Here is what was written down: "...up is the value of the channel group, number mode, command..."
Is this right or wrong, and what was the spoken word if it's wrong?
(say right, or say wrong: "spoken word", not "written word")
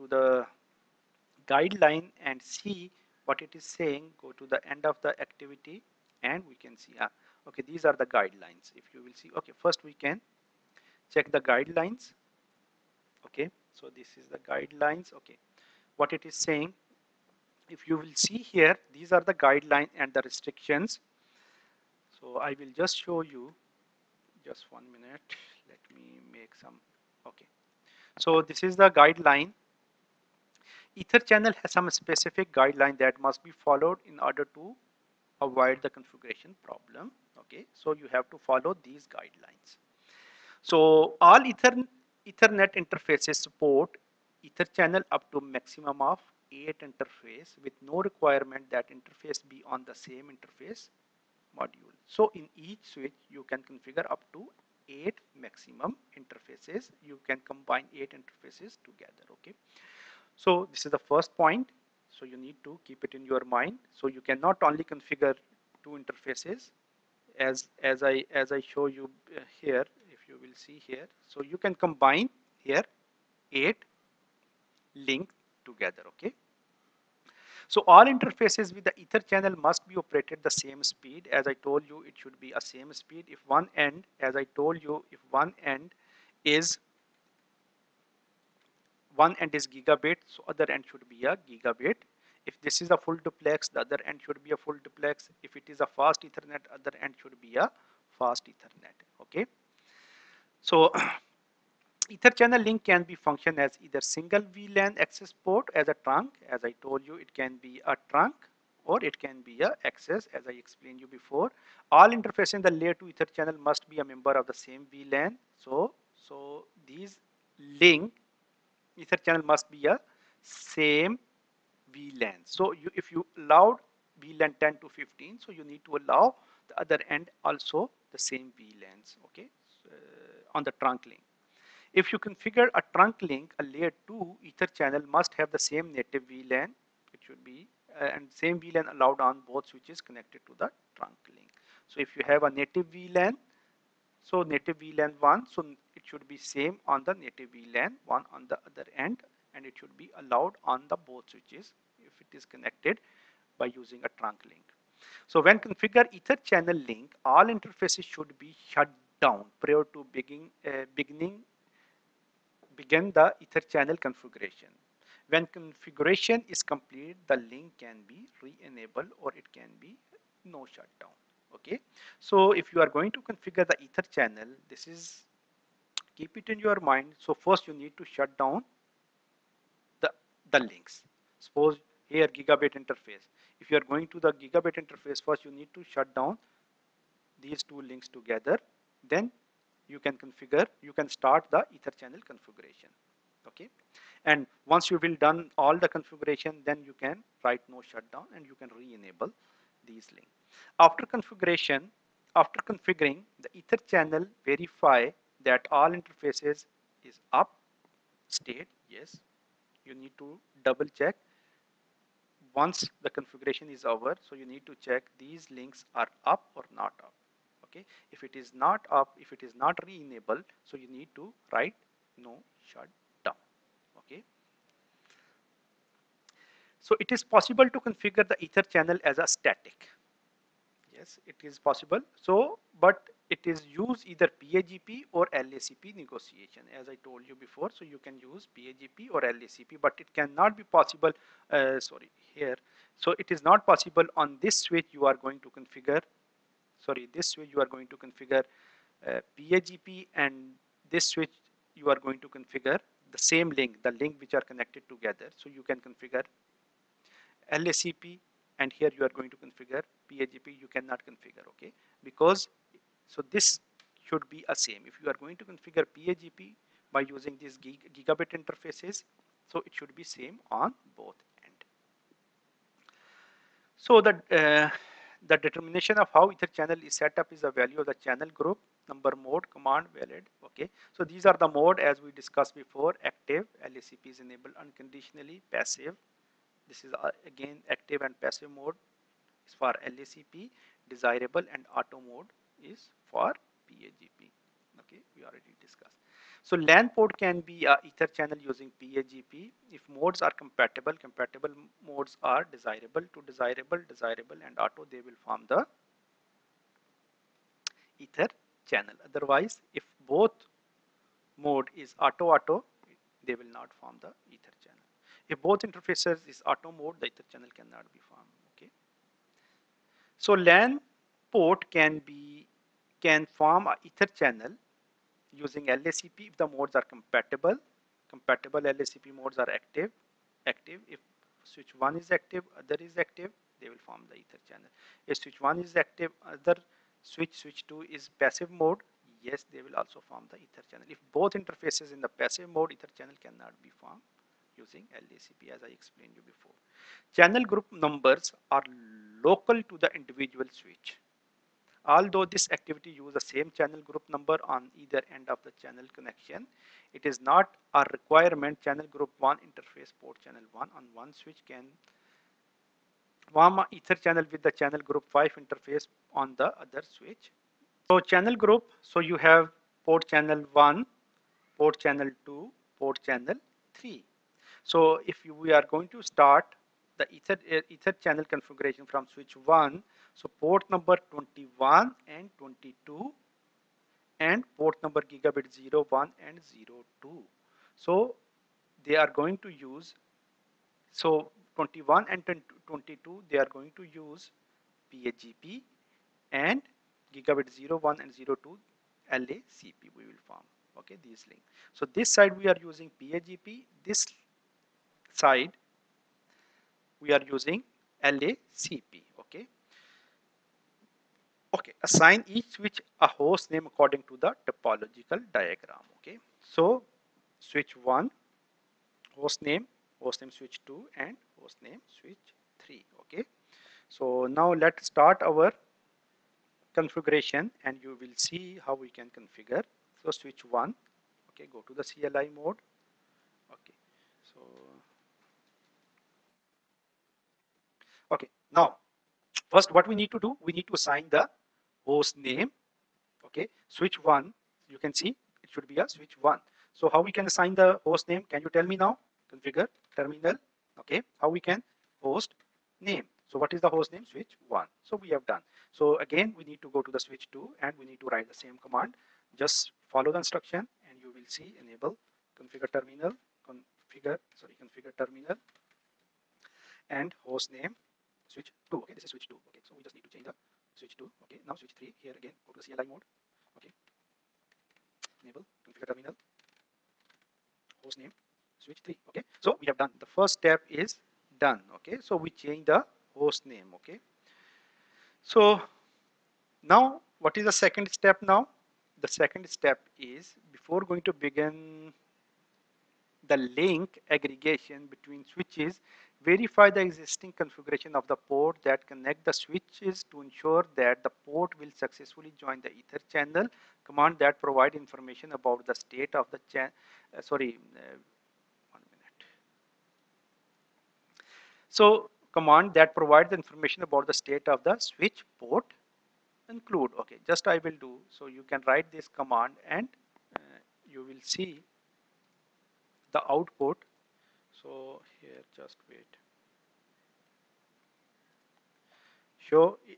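right.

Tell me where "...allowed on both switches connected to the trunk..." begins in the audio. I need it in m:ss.
2:18.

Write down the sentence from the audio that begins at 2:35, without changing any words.
So when configure ether channel link, all interfaces should be shut down prior to begin, uh, beginning begin the ether channel configuration.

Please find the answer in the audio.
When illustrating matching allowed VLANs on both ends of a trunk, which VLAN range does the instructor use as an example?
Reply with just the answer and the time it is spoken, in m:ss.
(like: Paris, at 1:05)
10 to 15, at 2:04.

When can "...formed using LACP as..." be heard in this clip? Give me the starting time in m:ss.
5:43.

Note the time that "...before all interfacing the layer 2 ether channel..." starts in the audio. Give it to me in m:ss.
1:51.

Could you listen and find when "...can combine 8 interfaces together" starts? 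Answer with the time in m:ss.
0:57.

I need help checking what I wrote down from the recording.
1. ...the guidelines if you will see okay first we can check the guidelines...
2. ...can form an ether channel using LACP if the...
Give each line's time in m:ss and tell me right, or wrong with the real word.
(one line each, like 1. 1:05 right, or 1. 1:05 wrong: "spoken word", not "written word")
1. 0:07 right
2. 5:23 right.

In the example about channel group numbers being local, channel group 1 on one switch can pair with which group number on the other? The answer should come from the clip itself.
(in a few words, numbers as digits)
5.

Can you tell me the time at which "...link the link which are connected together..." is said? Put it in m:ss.
4:13.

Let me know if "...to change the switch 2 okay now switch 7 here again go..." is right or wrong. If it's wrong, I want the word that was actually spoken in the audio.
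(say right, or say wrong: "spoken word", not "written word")
wrong: "3", not "7".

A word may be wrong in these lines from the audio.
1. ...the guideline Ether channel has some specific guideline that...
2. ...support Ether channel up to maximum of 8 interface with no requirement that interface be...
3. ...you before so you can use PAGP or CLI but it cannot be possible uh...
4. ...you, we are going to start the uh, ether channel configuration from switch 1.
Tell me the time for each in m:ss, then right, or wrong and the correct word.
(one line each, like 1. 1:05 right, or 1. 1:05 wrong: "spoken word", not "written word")
1. 0:28 right
2. 0:43 right
3. 3:57 wrong: "LACP", not "CLI"
4. 6:15 right.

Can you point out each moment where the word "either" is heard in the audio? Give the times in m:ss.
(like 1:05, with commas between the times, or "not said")
1:43, 3:54, 5:54.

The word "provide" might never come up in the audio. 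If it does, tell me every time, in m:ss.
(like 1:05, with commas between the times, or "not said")
8:24, 8:32.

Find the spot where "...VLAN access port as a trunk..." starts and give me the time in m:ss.
1:44.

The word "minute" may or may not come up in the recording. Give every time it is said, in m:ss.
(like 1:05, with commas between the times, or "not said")
0:24, 8:28.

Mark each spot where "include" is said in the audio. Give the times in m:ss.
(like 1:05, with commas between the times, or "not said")
8:36.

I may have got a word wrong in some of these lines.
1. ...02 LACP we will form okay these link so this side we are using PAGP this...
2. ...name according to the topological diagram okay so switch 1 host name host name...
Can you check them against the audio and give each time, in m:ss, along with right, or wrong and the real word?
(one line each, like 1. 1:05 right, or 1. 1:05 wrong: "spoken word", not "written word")
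1. 6:38 right
2. 6:53 right.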